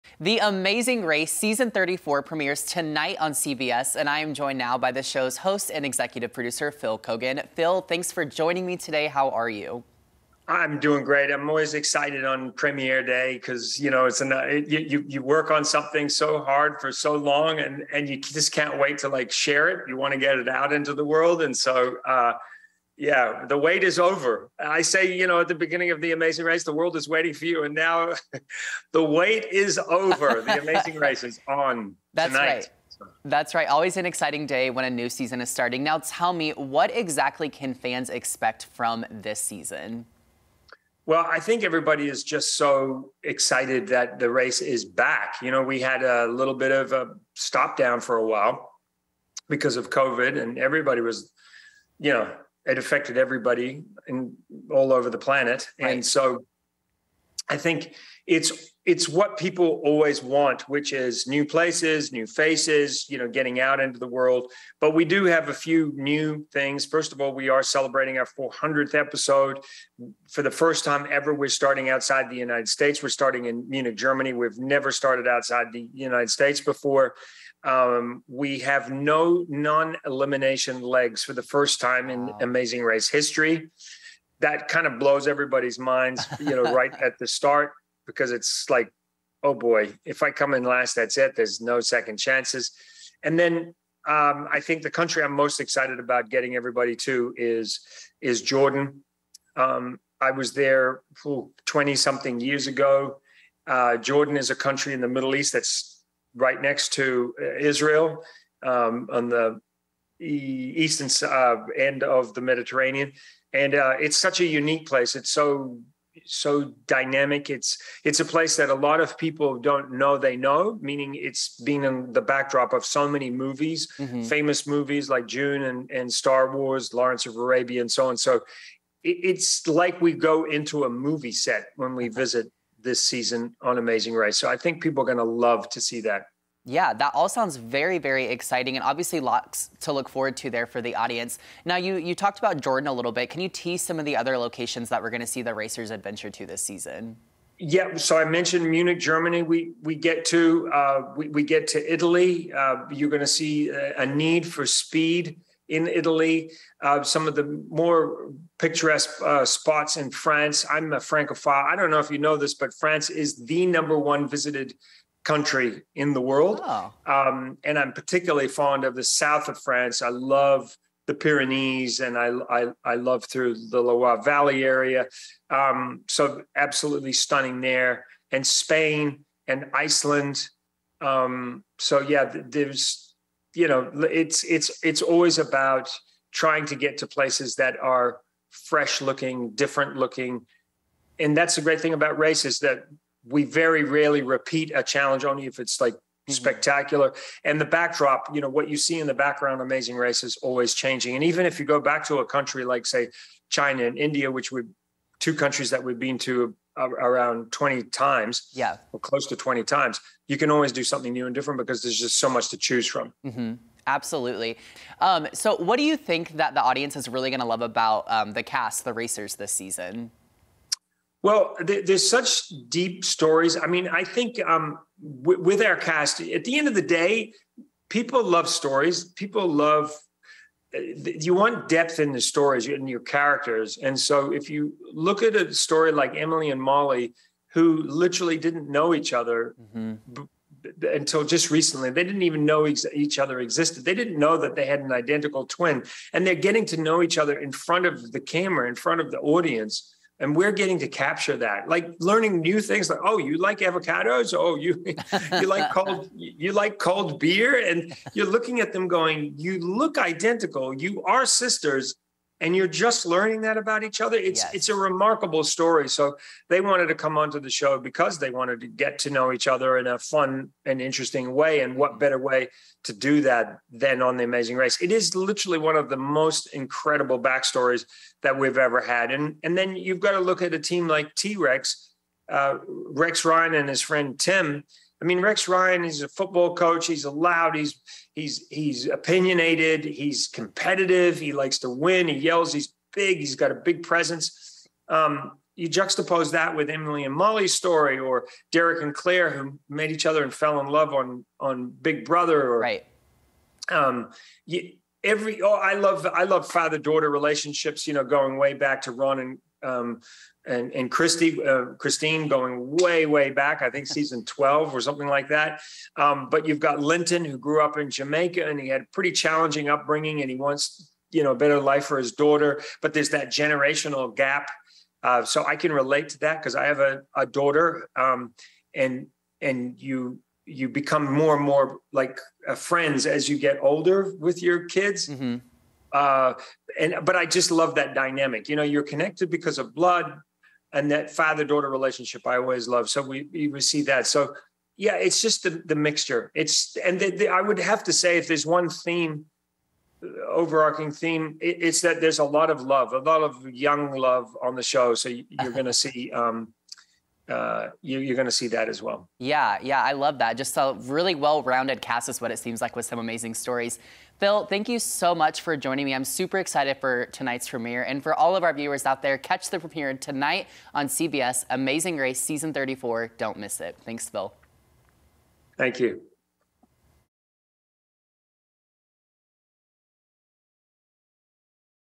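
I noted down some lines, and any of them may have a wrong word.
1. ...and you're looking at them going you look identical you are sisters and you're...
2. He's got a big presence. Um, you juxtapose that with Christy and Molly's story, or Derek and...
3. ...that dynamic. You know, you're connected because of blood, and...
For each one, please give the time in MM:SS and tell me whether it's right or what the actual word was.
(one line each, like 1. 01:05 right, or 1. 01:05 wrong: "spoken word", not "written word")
1. 04:17 right
2. 04:53 wrong: "Emily", not "Christy"
3. 05:37 right.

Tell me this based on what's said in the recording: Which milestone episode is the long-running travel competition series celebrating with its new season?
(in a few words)
400th.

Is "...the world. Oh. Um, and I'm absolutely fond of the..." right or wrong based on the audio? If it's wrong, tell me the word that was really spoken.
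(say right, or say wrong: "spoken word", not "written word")
wrong: "particularly", not "absolutely".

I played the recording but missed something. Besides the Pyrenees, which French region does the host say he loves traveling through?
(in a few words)
Loire Valley.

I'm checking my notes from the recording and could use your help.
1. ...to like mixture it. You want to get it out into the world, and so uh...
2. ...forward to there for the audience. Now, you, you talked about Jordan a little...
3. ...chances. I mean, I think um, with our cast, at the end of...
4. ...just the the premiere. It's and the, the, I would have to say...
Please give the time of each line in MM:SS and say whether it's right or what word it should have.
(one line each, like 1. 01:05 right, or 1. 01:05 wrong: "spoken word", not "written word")
1. 00:18 wrong: "share", not "mixture"
2. 02:20 right
3. 03:43 wrong: "stories", not "chances"
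4. 05:45 wrong: "mixture", not "premiere".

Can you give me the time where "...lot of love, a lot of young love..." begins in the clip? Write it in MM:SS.
05:52.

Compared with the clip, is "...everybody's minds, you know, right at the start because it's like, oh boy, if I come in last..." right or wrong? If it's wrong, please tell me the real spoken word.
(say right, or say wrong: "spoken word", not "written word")
right.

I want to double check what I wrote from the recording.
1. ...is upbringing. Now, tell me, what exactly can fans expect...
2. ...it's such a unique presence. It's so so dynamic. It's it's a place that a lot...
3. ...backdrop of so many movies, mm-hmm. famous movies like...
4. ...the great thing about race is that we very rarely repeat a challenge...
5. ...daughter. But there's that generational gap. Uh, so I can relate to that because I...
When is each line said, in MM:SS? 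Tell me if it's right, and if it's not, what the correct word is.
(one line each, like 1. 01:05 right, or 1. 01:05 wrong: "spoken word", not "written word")
1. 00:35 wrong: "starting", not "upbringing"
2. 01:53 wrong: "place", not "presence"
3. 02:02 right
4. 03:11 right
5. 05:22 right.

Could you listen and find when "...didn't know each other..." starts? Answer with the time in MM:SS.
03:58.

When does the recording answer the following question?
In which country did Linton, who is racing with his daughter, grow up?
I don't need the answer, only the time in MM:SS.
05:17.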